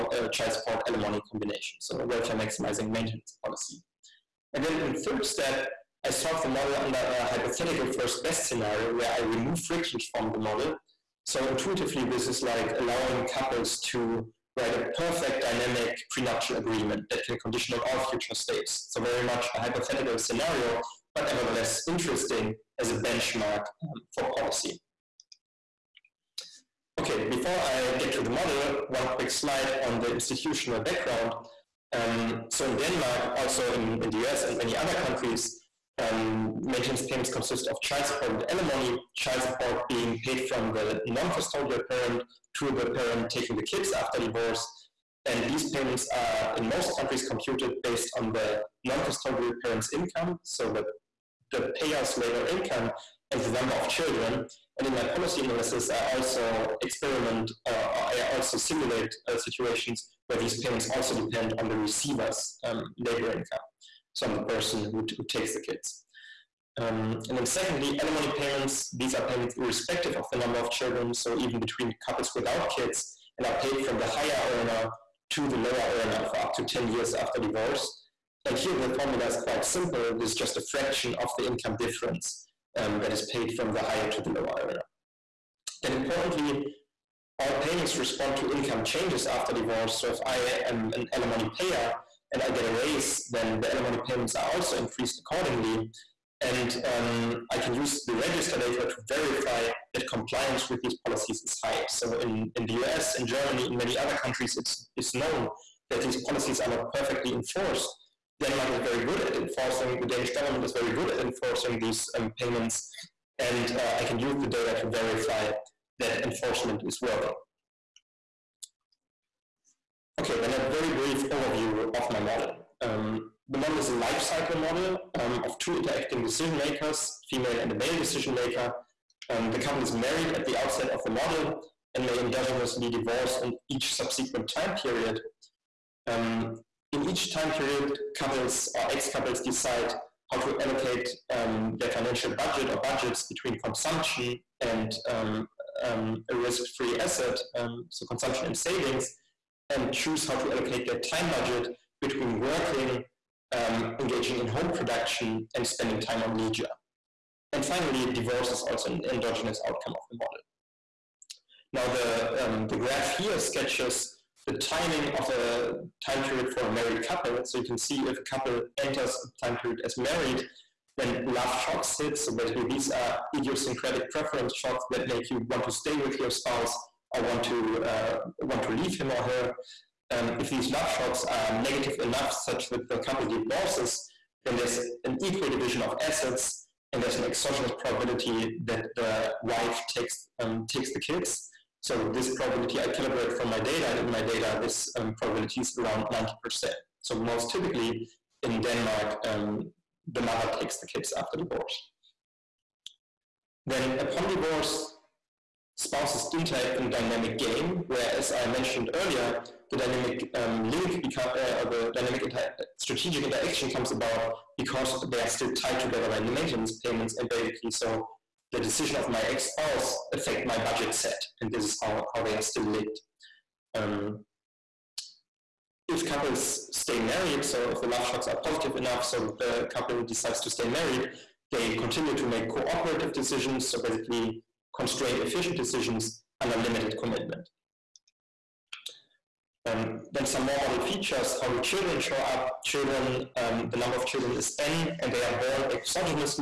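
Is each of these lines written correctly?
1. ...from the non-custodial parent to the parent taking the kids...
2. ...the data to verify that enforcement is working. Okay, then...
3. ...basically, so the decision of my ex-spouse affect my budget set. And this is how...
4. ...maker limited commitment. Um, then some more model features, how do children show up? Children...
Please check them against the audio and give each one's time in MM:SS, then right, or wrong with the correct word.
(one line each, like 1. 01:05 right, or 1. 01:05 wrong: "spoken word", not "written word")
1. 00:40 right
2. 01:54 right
3. 03:37 right
4. 03:56 wrong: "under", not "maker".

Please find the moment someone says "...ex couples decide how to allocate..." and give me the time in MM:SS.
02:18.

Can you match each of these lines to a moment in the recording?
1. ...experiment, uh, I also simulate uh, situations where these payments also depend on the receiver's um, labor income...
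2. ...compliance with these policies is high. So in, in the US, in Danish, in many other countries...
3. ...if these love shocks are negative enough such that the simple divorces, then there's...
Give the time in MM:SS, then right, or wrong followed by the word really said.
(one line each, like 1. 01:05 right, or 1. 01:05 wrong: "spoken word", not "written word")
1. 00:56 right
2. 01:40 wrong: "Germany", not "Danish"
3. 03:00 wrong: "couple", not "simple".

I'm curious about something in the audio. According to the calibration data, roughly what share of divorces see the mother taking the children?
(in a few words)
90%.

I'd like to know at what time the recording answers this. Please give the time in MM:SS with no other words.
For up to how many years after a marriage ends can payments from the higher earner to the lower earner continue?
01:16.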